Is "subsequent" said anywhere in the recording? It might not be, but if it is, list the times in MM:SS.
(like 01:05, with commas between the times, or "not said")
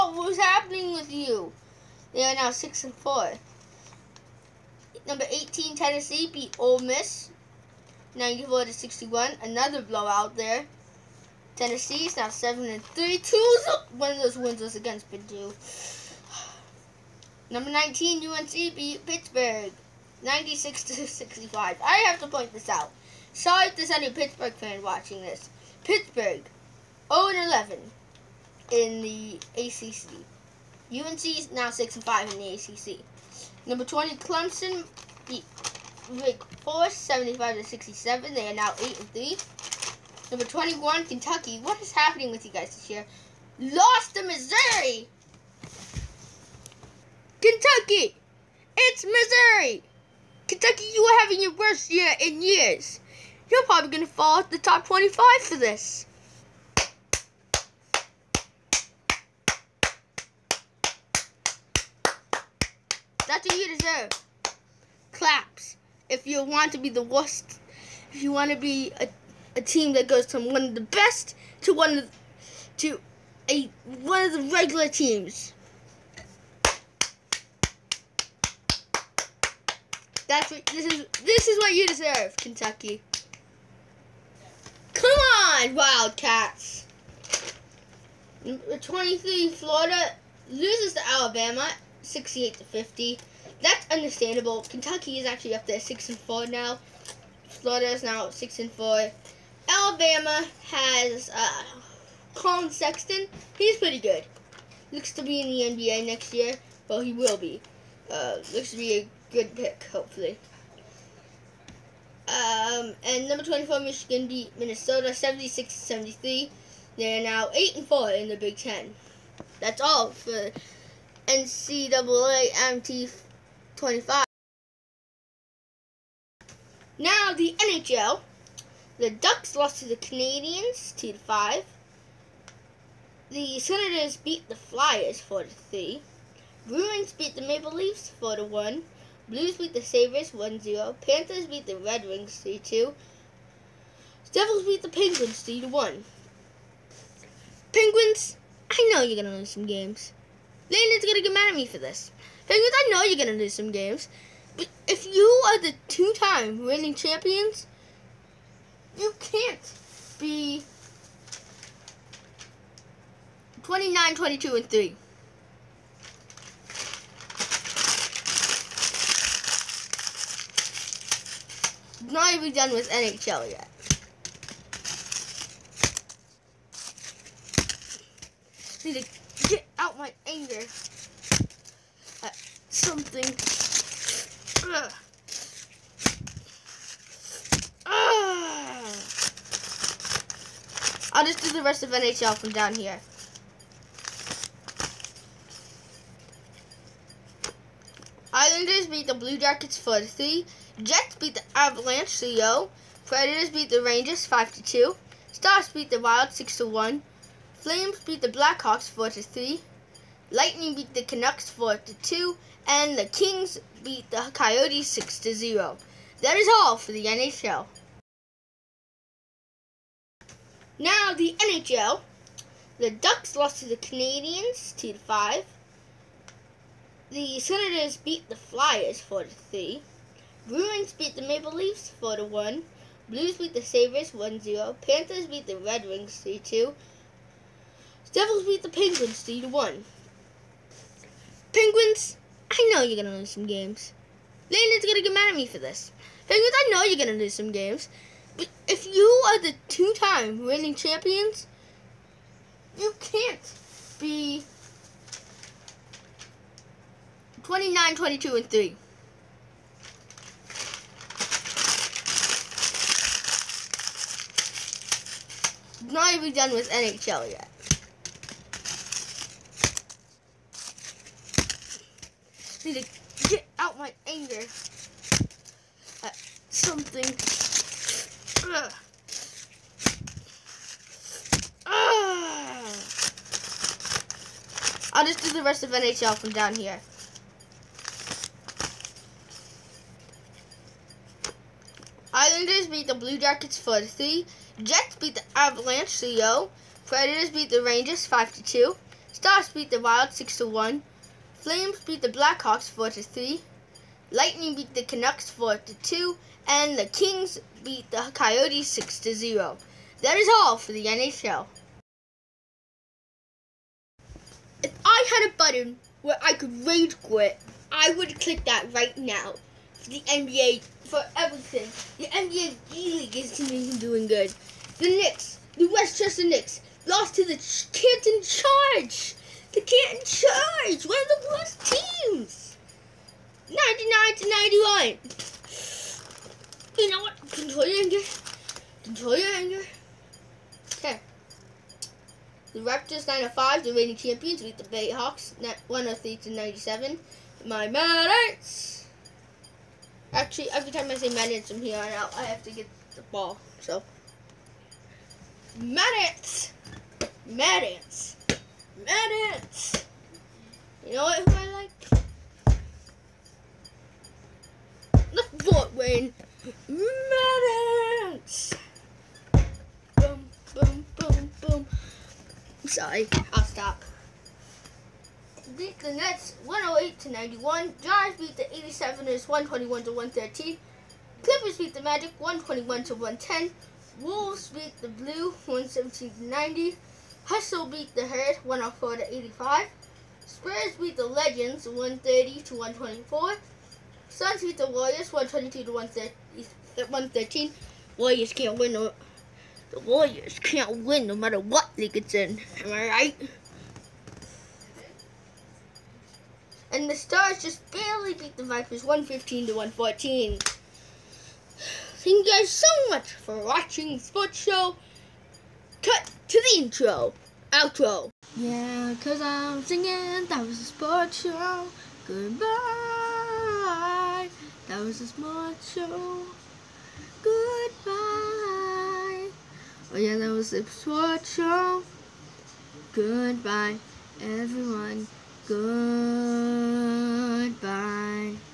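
not said.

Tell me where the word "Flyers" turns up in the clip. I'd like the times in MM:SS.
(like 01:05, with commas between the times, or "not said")
02:14, 03:48.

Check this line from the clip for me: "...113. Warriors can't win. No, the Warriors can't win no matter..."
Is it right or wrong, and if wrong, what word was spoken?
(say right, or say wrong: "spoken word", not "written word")
right.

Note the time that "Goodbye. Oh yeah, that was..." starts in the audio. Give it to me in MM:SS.
07:07.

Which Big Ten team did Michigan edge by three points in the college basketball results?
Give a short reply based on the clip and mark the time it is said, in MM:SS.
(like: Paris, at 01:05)
Minnesota, at 01:54.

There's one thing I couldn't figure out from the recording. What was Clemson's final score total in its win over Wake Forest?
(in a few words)
75.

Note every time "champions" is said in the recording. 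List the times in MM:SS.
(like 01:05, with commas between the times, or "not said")
02:36, 04:10, 05:43.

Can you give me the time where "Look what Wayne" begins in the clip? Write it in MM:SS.
06:05.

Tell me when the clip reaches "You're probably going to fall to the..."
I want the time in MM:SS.
00:53.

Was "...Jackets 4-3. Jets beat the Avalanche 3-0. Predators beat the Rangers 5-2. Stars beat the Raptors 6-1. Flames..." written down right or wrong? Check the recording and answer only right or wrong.
wrong.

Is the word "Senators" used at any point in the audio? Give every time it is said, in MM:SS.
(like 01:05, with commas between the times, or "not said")
02:13, 03:47.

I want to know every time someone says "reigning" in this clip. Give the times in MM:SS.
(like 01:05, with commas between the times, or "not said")
02:36, 04:10, 05:43.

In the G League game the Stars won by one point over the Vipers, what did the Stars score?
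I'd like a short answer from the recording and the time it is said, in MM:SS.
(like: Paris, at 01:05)
115, at 06:48.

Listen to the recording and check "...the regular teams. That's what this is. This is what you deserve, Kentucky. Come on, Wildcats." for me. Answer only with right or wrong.
right.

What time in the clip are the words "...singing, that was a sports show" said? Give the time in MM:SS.
06:59.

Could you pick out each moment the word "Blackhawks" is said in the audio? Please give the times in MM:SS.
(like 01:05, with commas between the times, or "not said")
03:28, 05:02.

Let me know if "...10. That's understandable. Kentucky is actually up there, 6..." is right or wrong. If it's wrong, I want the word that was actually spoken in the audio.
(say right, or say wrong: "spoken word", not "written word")
wrong: "50", not "10".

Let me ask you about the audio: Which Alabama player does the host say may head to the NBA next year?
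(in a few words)
Collin Sexton.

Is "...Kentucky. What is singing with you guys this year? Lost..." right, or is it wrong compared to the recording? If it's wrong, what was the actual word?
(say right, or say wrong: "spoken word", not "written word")
wrong: "happening", not "singing".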